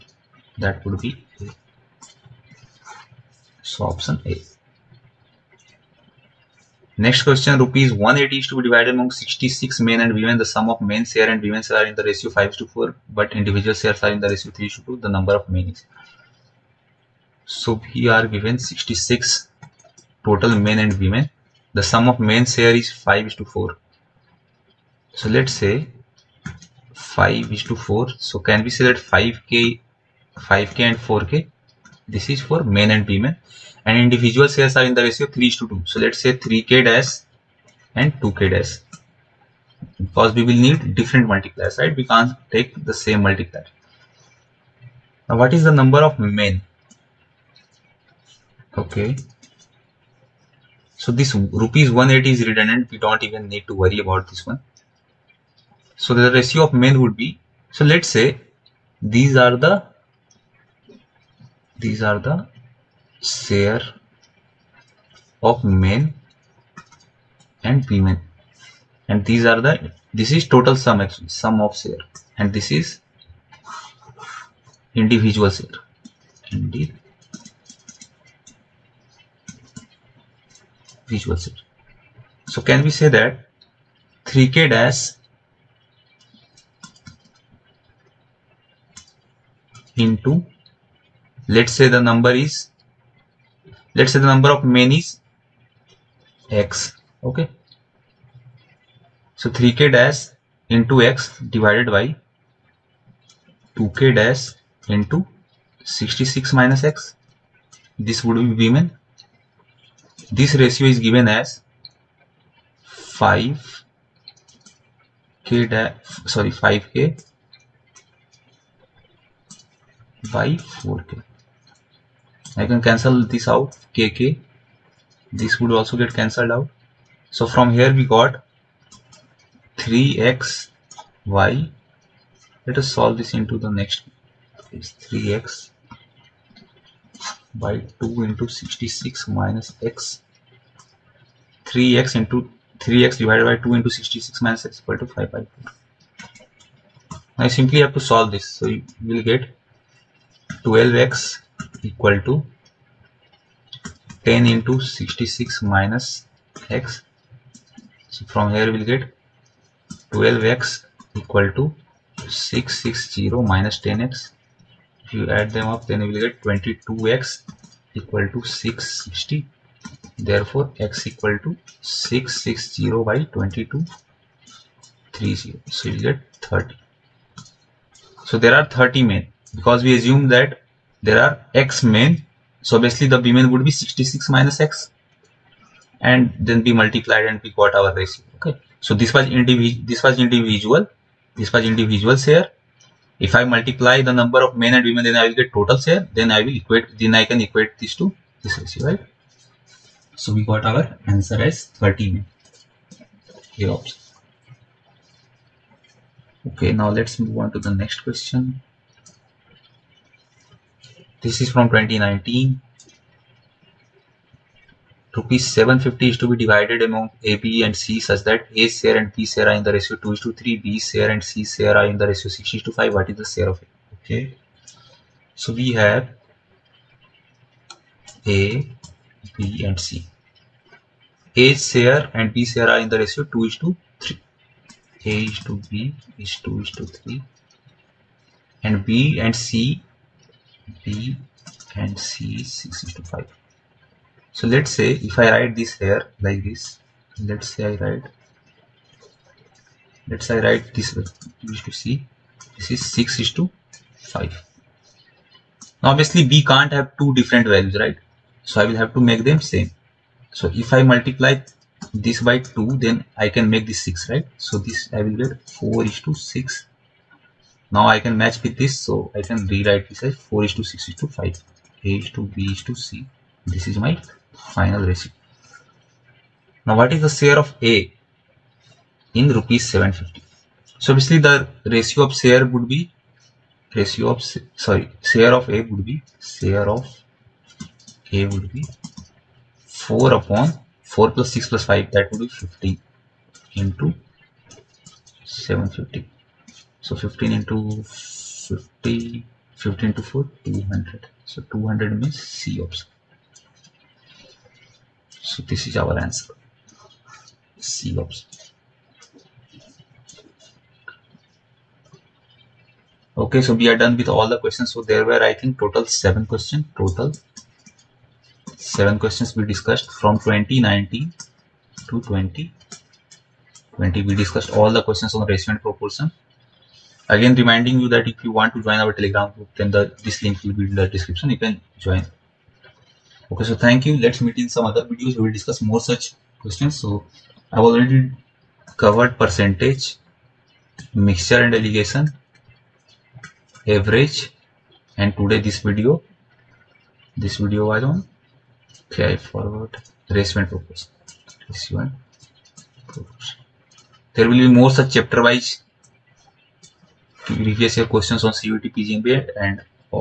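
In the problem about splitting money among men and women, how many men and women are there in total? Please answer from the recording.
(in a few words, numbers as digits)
66.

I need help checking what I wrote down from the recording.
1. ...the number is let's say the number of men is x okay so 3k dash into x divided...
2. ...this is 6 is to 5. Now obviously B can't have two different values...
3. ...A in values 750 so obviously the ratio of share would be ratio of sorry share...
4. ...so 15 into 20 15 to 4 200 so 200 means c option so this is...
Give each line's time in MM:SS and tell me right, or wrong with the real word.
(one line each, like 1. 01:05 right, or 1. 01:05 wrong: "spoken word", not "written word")
1. 01:31 right
2. 04:12 right
3. 04:37 wrong: "rupees", not "values"
4. 04:56 wrong: "50", not "20".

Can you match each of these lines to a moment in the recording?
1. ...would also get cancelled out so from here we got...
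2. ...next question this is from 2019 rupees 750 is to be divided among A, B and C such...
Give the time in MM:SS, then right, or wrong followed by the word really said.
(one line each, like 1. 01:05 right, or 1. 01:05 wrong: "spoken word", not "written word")
1. 02:05 right
2. 03:27 right.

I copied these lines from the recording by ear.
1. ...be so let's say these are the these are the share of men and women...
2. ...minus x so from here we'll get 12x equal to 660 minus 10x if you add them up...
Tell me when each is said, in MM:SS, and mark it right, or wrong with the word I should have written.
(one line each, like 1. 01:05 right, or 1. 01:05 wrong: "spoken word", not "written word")
1. 00:57 right
2. 02:35 right.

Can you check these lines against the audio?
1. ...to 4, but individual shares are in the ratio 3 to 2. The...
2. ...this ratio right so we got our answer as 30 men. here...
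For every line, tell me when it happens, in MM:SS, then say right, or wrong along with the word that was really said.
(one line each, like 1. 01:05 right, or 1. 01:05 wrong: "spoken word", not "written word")
1. 00:12 right
2. 03:18 right.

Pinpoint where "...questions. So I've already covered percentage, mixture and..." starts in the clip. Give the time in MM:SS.
05:36.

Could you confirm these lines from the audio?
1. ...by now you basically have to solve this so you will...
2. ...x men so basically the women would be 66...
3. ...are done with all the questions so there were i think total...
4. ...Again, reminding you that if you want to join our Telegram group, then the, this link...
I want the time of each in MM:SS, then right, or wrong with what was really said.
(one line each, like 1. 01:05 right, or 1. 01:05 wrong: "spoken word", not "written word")
1. 02:25 wrong: "simply", not "basically"
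2. 03:01 right
3. 05:13 right
4. 05:27 right.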